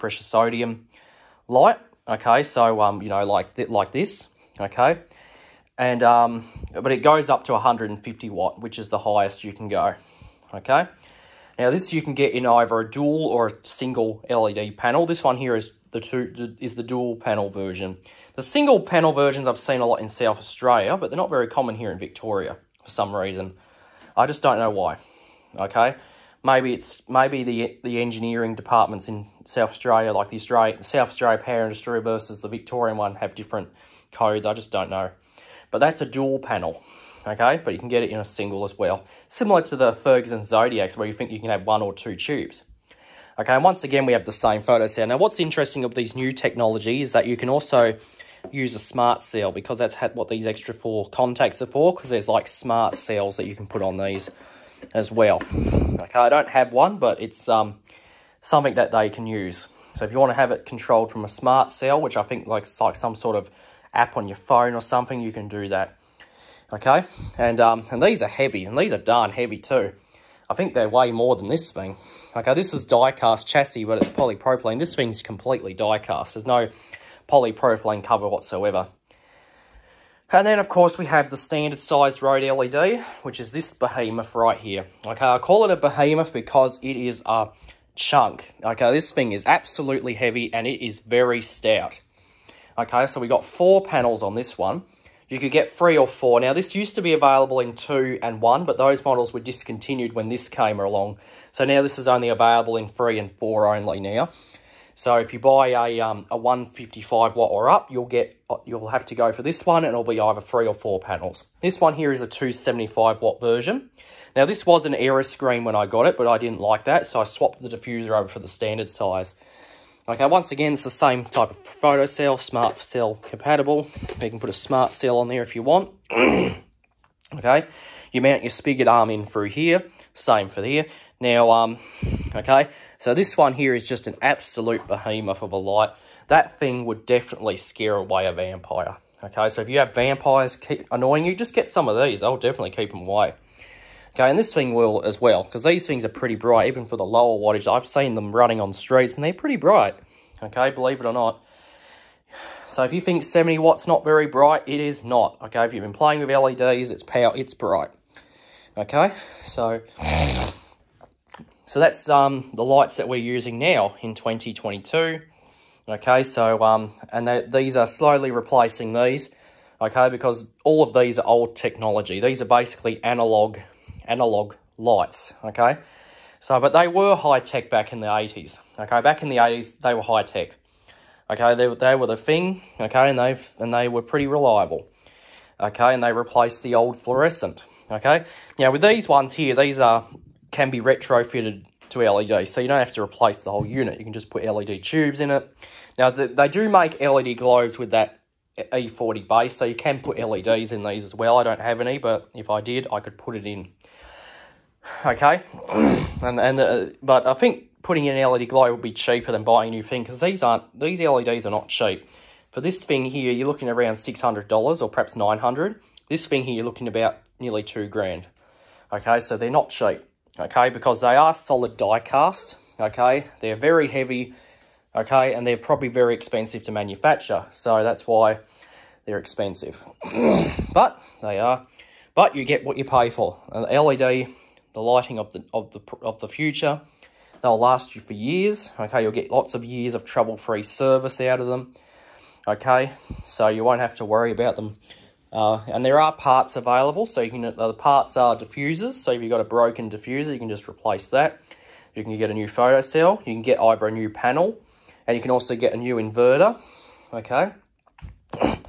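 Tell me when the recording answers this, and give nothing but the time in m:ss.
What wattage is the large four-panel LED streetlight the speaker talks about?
1:52.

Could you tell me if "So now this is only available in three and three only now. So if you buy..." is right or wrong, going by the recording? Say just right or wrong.
wrong.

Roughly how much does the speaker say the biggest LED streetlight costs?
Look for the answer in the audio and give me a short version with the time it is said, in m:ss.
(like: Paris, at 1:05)
nearly 2 grand, at 3:37.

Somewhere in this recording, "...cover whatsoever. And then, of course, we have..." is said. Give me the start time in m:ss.
1:18.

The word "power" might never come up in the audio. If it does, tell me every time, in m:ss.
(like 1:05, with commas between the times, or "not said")
0:31, 2:37.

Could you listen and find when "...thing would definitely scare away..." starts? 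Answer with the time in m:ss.
2:16.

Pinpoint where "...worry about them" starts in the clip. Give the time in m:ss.
4:04.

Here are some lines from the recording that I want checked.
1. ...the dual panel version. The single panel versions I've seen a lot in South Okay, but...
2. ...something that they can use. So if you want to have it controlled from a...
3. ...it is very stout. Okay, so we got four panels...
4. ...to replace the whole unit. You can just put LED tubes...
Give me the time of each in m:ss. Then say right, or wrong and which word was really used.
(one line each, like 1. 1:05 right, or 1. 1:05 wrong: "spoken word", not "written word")
1. 0:16 wrong: "Australia", not "Okay"
2. 0:58 right
3. 1:30 right
4. 3:12 right.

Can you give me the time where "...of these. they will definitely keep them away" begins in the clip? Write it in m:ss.
2:21.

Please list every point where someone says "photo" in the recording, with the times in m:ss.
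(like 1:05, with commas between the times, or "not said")
0:44, 2:01, 4:12.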